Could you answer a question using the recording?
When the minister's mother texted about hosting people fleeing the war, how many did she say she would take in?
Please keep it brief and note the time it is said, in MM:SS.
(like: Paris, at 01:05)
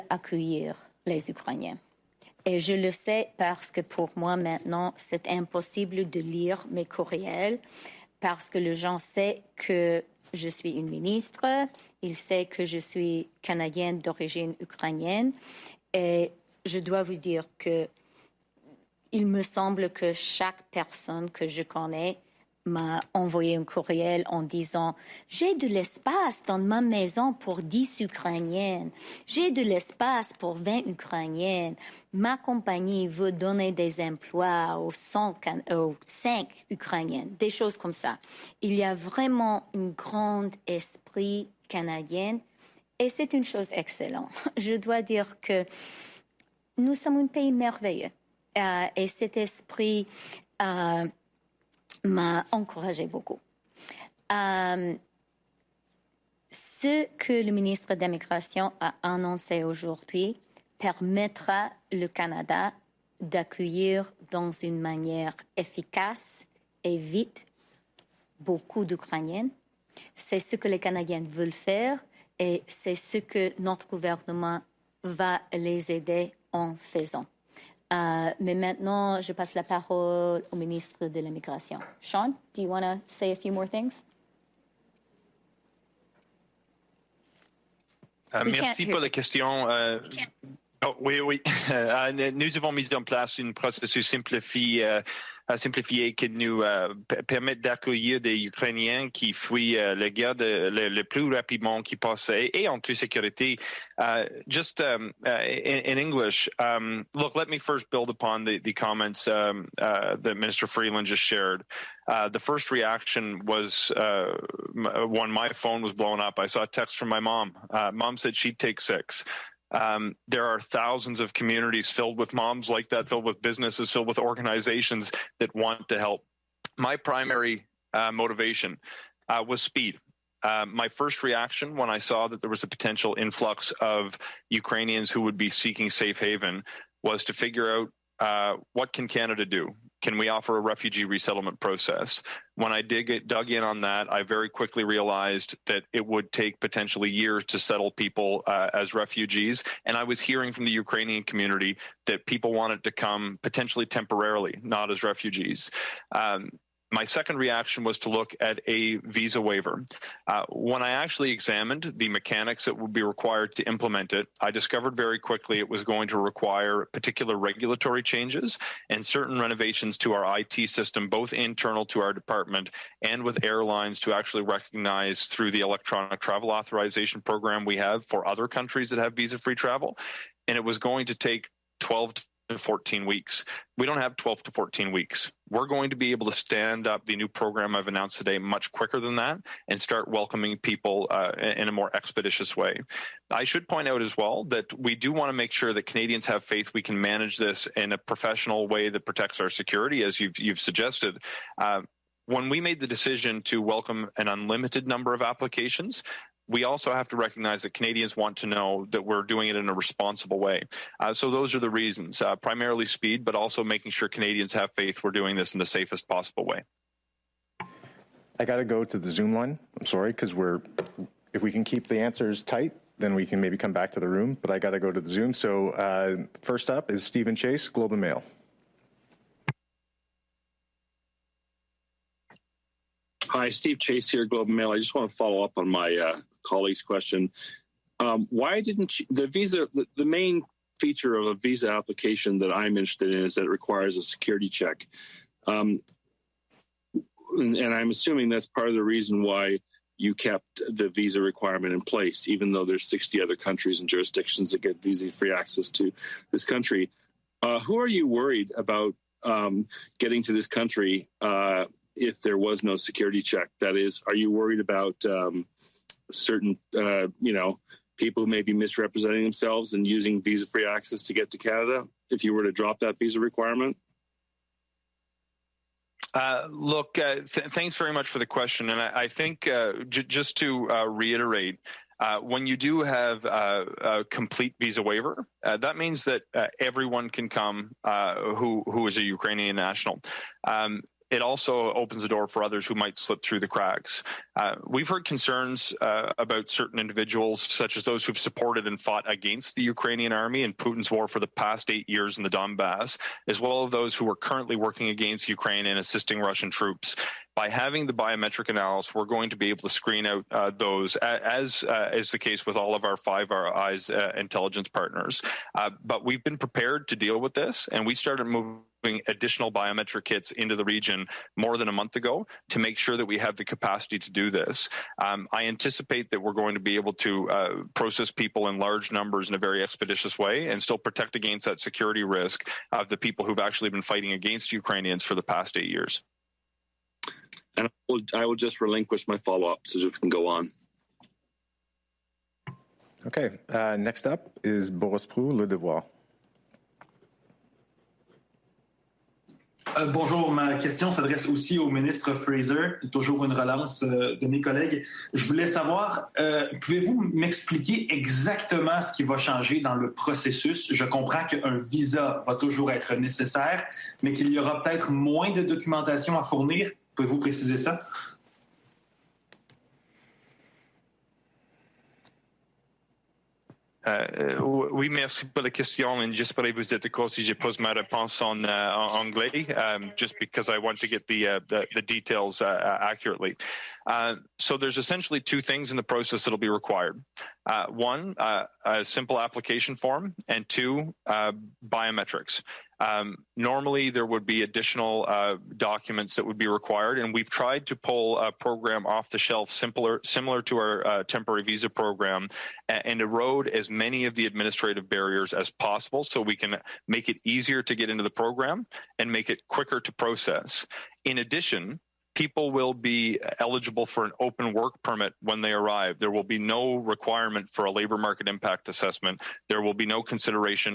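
6, at 01:58.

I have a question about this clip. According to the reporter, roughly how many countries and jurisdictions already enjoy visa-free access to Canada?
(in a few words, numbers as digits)
60.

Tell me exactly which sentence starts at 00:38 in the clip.
Il y a vraiment un grand esprit canadien et c'est une chose excellente.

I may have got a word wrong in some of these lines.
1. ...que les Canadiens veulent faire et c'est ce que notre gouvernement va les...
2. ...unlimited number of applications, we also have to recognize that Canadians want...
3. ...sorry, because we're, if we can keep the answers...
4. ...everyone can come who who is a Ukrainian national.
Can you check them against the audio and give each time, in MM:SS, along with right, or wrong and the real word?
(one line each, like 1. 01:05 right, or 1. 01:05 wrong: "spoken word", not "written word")
1. 01:10 right
2. 03:24 right
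3. 03:39 right
4. 04:46 right.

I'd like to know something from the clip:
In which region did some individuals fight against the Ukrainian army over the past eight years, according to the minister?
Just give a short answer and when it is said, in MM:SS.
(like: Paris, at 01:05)
Donbass, at 05:02.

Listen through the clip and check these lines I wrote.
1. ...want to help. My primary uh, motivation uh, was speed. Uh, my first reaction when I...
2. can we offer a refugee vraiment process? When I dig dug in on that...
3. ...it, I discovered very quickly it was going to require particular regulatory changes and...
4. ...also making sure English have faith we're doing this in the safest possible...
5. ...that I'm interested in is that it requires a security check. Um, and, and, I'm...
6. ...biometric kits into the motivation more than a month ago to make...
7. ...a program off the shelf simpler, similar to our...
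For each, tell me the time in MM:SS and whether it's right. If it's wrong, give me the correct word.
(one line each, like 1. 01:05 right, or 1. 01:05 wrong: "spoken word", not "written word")
1. 02:05 right
2. 02:20 wrong: "resettlement", not "vraiment"
3. 02:44 right
4. 03:33 wrong: "Canadians", not "English"
5. 04:02 right
6. 05:19 wrong: "region", not "motivation"
7. 06:38 right.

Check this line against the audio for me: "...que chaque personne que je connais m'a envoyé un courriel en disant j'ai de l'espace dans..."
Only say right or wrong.
right.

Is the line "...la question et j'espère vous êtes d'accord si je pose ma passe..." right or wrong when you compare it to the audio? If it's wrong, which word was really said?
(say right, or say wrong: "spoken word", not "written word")
wrong: "réponse", not "passe".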